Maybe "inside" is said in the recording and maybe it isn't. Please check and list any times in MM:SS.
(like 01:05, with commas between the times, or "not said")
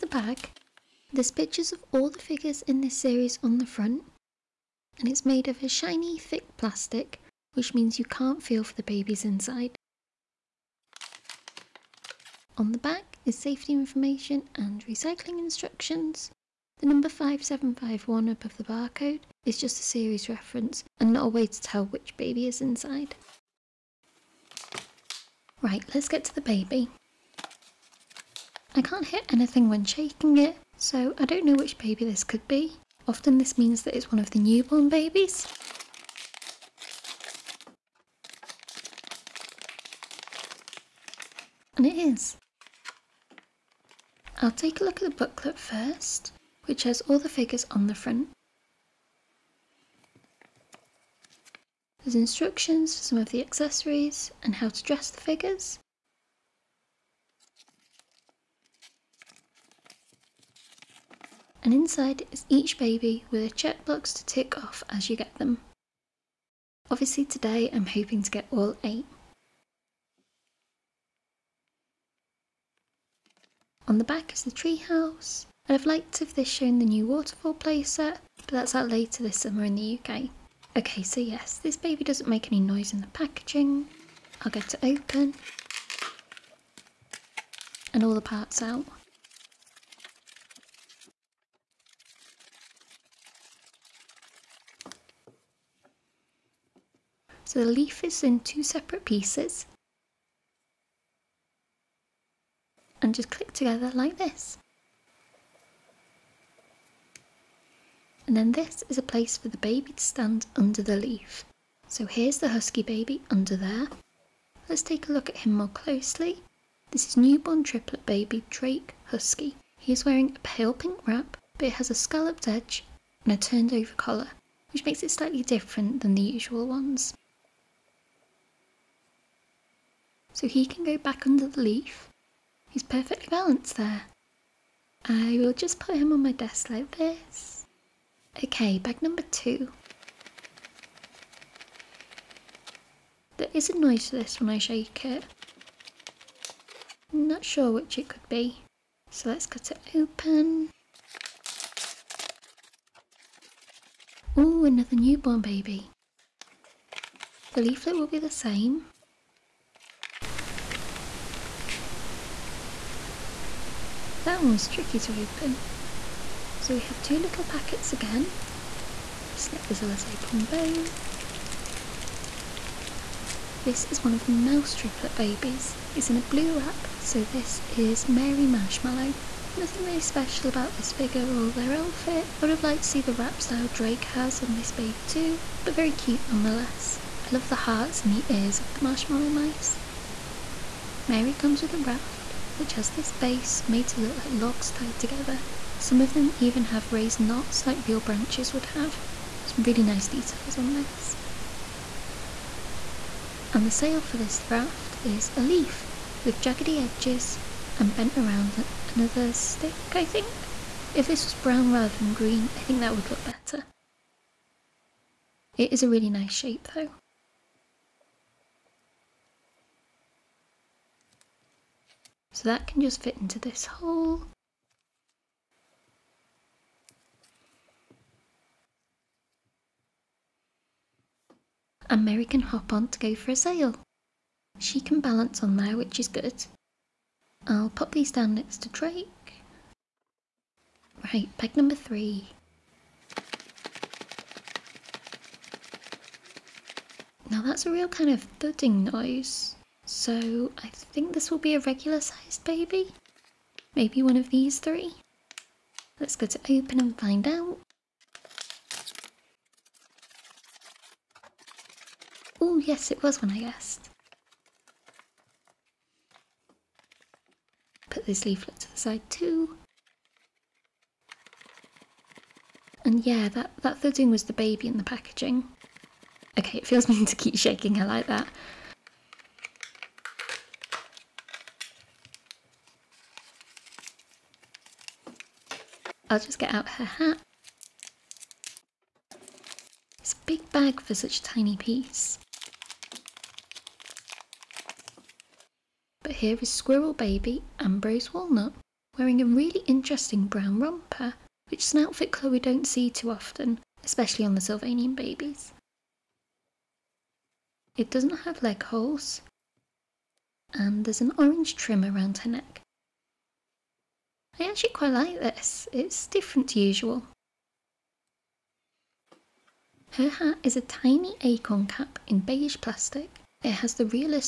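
00:09, 00:22, 01:01.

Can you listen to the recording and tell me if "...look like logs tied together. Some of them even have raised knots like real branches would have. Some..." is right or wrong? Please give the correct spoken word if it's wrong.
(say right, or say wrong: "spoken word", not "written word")
right.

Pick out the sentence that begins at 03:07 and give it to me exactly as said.
I love the hearts and the ears of the marshmallow mice.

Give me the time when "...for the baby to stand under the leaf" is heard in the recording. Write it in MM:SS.
01:49.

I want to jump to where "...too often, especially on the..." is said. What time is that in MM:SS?
05:02.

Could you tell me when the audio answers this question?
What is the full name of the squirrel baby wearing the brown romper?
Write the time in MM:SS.
04:57.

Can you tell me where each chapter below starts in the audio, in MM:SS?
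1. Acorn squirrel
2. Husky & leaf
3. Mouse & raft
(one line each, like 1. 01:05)
1. 03:59
2. 00:24
3. 02:18.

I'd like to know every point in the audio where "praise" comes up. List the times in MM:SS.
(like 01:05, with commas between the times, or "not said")
not said.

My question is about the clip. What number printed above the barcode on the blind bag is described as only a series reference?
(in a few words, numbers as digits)
5751.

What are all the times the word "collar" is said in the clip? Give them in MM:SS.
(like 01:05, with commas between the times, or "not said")
02:03.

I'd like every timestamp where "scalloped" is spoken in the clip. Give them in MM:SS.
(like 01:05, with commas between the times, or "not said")
02:01.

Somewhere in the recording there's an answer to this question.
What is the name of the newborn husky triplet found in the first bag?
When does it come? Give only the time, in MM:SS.
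01:58.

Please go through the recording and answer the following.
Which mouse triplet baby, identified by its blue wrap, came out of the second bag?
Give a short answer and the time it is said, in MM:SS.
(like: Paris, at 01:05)
Mary Marshmallow, at 02:58.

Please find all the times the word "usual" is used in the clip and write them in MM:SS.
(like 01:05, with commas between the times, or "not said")
02:06, 05:16.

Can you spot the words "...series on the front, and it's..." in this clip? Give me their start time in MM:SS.
00:02.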